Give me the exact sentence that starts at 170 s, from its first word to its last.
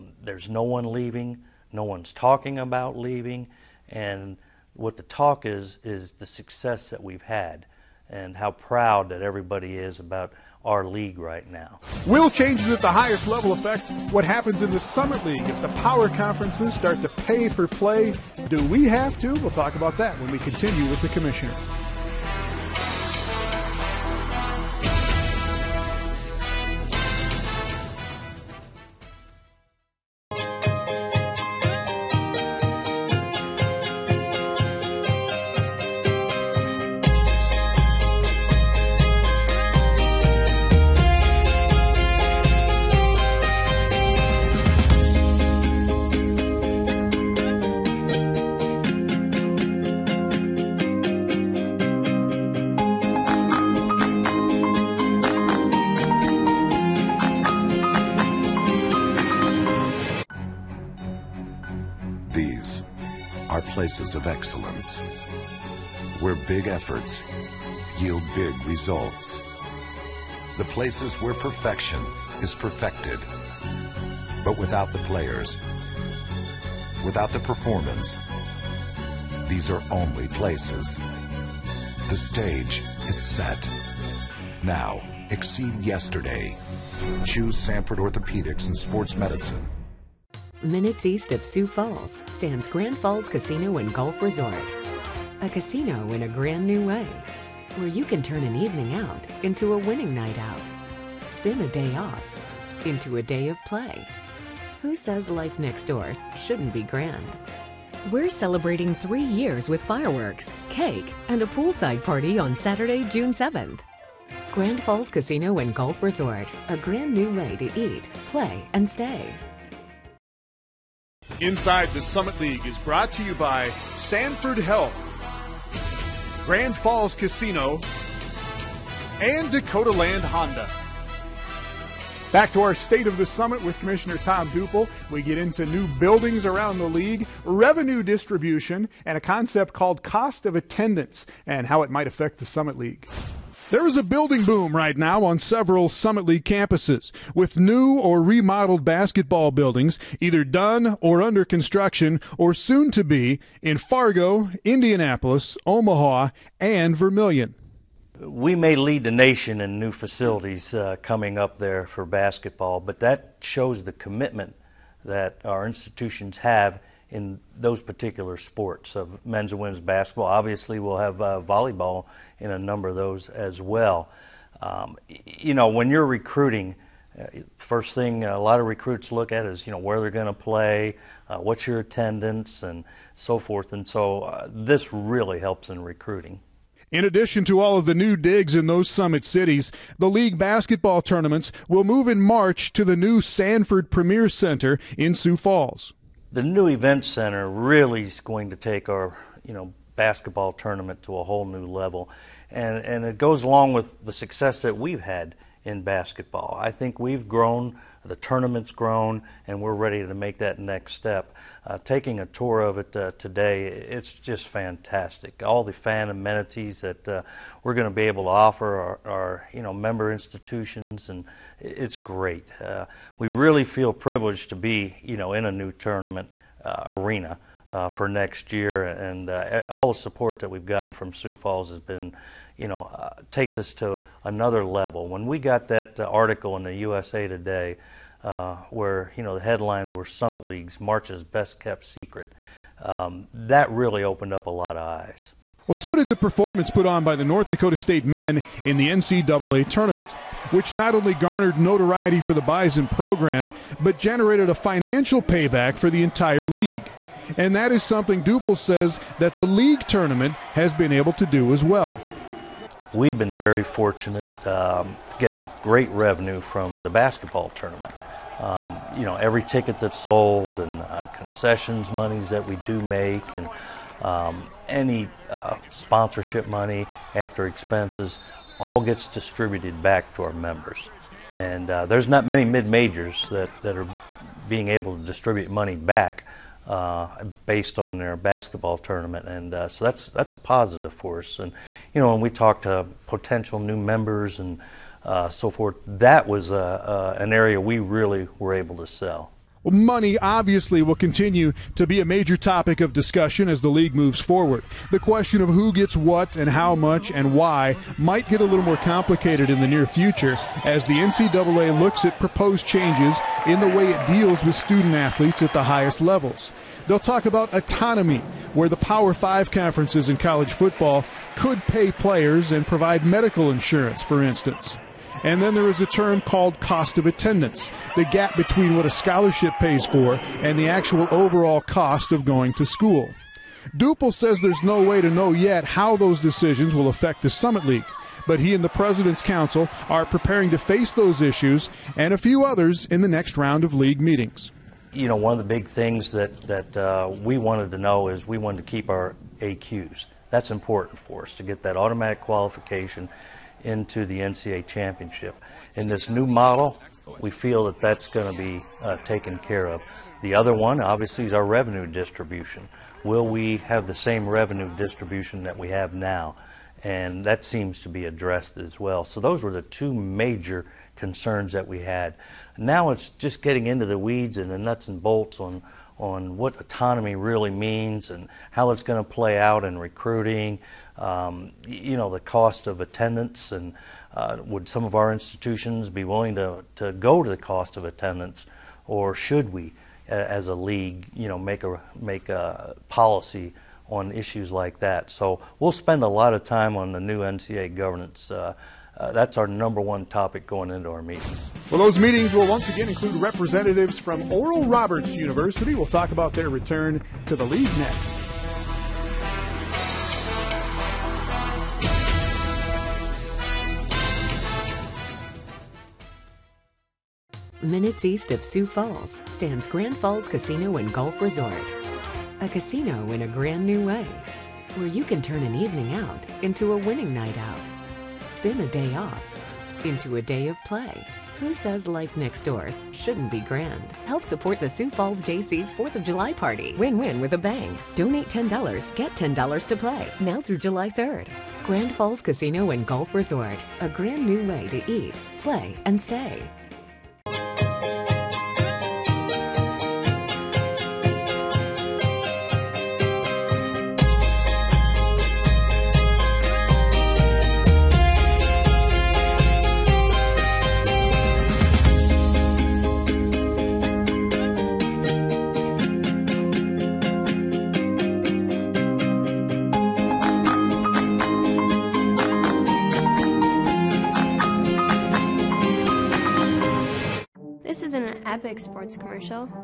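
Obviously, we'll have uh, volleyball in a number of those as well.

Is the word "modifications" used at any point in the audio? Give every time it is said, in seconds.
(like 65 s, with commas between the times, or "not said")
not said.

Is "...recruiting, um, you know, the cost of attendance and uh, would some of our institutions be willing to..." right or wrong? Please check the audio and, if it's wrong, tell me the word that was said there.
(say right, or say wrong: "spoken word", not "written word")
right.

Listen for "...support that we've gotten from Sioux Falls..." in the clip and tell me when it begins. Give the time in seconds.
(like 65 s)
229 s.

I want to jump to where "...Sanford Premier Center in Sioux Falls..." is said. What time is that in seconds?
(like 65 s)
193 s.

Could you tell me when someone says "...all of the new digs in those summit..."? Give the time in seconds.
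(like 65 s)
187 s.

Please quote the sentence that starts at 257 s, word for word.
And that is something Douple says that the league tournament has been able to do as well.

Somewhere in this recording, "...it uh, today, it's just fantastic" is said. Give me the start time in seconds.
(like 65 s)
212 s.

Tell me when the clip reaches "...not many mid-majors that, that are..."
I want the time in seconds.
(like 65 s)
282 s.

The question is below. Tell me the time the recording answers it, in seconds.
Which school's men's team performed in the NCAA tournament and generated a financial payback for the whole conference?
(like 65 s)
247 s.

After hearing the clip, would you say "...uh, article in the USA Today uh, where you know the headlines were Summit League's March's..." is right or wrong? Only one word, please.
right.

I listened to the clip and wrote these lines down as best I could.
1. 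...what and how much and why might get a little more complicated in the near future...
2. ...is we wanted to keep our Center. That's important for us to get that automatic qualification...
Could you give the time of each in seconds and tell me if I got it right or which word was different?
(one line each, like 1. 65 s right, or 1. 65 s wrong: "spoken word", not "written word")
1. 305 s right
2. 348 s wrong: "AQs", not "Center".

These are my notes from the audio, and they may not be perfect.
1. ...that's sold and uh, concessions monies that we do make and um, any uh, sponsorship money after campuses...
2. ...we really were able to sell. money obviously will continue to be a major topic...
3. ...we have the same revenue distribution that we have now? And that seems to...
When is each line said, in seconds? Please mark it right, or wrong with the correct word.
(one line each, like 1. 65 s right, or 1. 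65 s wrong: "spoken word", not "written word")
1. 269 s wrong: "expenses", not "campuses"
2. 297 s right
3. 363 s right.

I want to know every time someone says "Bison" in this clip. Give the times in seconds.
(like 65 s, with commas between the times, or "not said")
252 s.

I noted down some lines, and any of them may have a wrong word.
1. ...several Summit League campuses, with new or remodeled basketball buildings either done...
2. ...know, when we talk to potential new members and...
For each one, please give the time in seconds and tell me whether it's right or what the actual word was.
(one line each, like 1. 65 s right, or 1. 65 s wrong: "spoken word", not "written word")
1. 145 s right
2. 292 s right.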